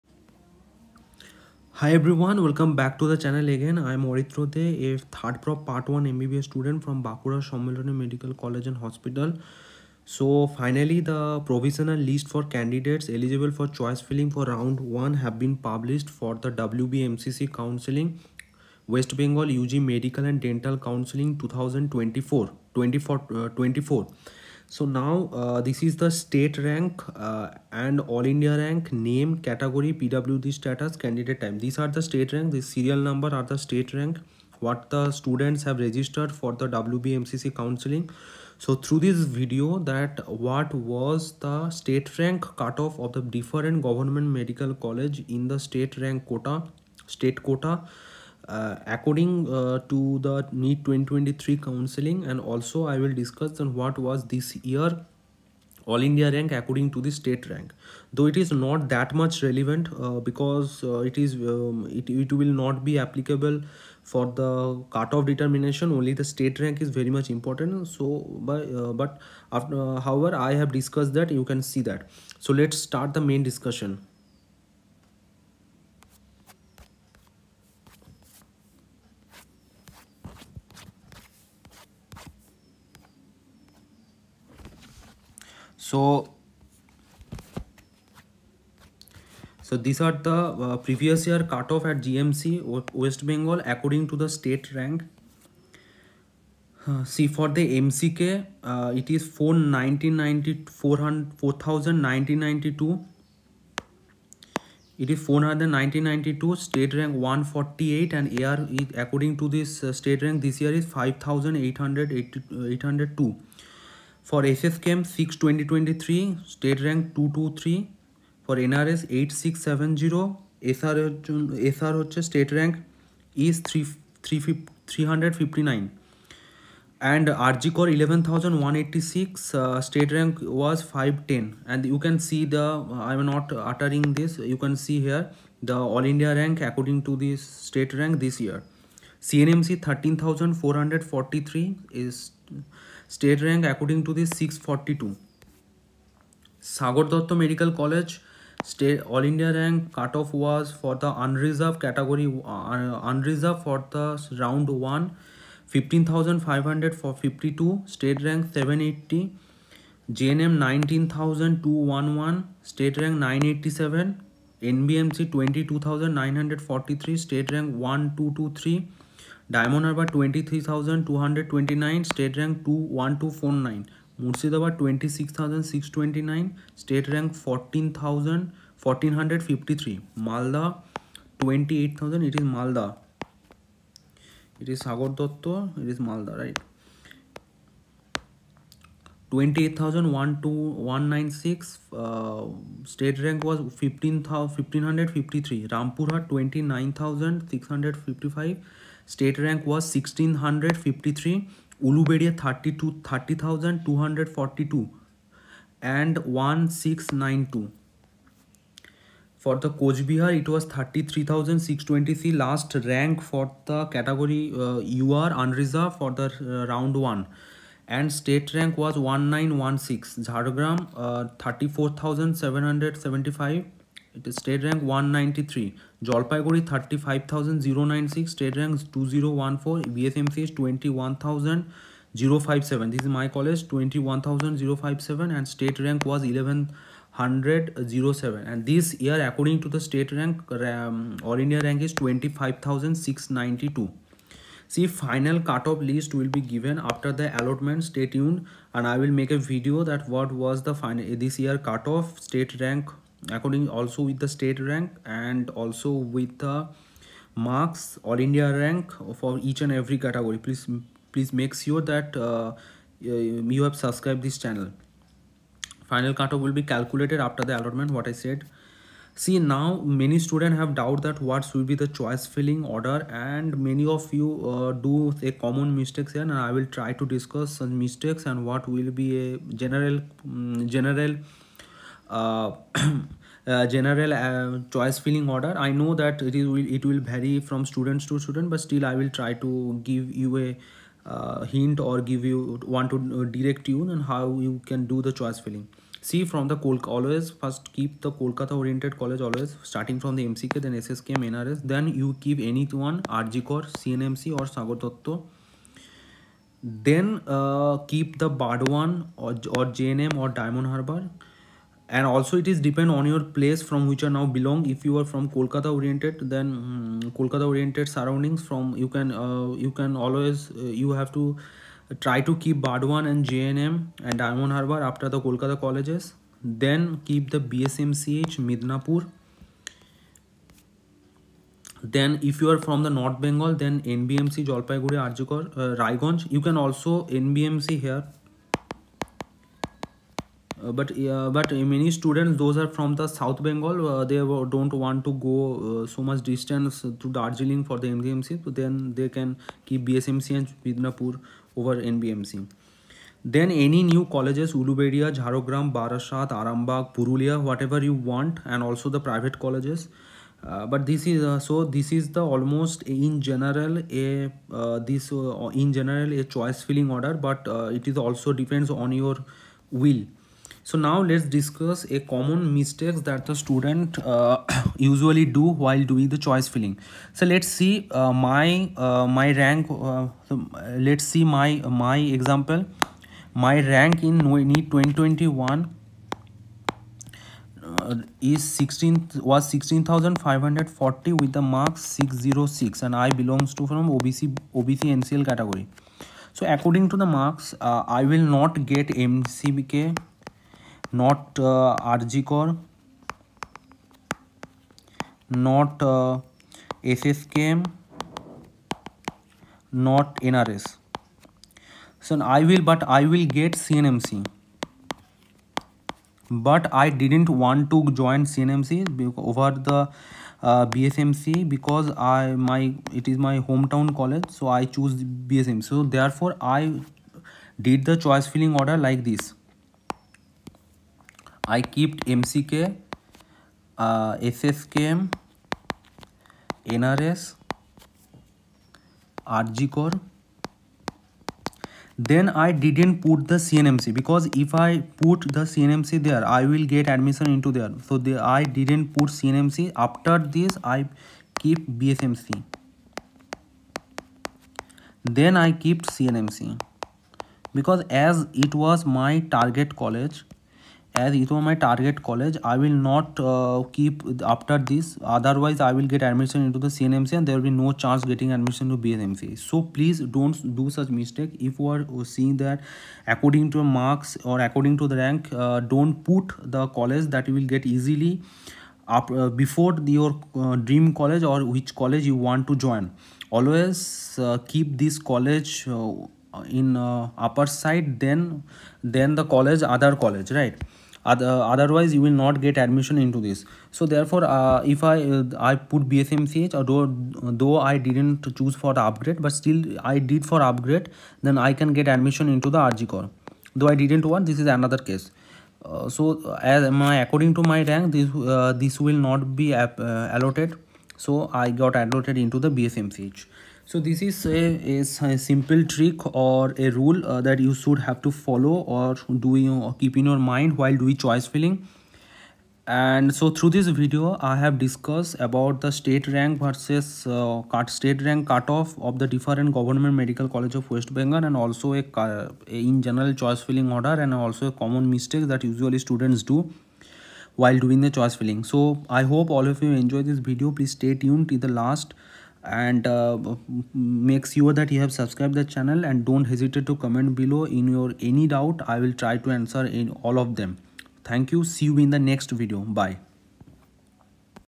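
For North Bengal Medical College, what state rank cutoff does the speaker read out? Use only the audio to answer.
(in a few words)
1223.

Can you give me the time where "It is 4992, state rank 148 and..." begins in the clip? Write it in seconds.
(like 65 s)
104 s.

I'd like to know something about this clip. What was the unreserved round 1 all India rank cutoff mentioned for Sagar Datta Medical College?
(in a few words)
15500.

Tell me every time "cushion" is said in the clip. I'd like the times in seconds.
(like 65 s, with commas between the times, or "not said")
not said.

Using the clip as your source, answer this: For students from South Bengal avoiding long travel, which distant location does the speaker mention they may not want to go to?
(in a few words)
Darjeeling.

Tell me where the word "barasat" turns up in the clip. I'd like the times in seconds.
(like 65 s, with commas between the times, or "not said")
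355 s.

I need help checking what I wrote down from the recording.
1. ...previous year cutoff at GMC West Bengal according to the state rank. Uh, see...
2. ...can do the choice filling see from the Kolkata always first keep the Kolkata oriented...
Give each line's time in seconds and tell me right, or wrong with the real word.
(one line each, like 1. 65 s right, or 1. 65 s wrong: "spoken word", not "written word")
1. 90 s right
2. 294 s right.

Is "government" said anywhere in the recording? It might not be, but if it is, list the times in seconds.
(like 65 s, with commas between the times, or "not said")
43 s, 529 s.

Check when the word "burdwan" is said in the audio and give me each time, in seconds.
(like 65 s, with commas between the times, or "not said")
322 s.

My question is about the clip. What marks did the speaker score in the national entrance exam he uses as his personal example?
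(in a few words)
606.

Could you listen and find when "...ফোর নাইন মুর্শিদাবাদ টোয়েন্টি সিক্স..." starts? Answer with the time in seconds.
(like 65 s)
173 s.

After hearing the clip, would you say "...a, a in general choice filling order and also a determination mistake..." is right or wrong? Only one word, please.
wrong.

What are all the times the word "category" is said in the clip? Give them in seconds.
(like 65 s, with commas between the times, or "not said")
29 s, 151 s, 259 s, 395 s.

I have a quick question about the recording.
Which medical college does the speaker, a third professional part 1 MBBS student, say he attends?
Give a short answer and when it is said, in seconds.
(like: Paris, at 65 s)
Bankura Sammilani Medical College, at 7 s.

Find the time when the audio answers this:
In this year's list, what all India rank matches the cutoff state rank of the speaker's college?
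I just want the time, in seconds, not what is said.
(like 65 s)
241 s.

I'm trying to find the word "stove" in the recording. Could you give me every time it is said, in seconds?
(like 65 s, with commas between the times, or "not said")
not said.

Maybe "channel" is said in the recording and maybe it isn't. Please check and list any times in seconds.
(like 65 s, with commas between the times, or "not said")
3 s, 264 s, 545 s.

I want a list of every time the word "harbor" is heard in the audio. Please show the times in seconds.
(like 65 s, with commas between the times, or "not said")
310 s, 324 s.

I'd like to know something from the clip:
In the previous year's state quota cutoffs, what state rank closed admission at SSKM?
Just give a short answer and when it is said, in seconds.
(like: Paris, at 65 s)
223, at 116 s.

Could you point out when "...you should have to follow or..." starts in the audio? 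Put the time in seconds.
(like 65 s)
517 s.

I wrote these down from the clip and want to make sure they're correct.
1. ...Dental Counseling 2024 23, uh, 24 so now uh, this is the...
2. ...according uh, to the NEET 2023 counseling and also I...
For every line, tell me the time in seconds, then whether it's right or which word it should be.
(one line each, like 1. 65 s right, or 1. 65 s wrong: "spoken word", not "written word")
1. 20 s wrong: "24", not "23"
2. 48 s right.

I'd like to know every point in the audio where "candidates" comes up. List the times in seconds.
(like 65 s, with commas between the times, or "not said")
12 s, 31 s.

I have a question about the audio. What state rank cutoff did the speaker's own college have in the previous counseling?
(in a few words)
1107.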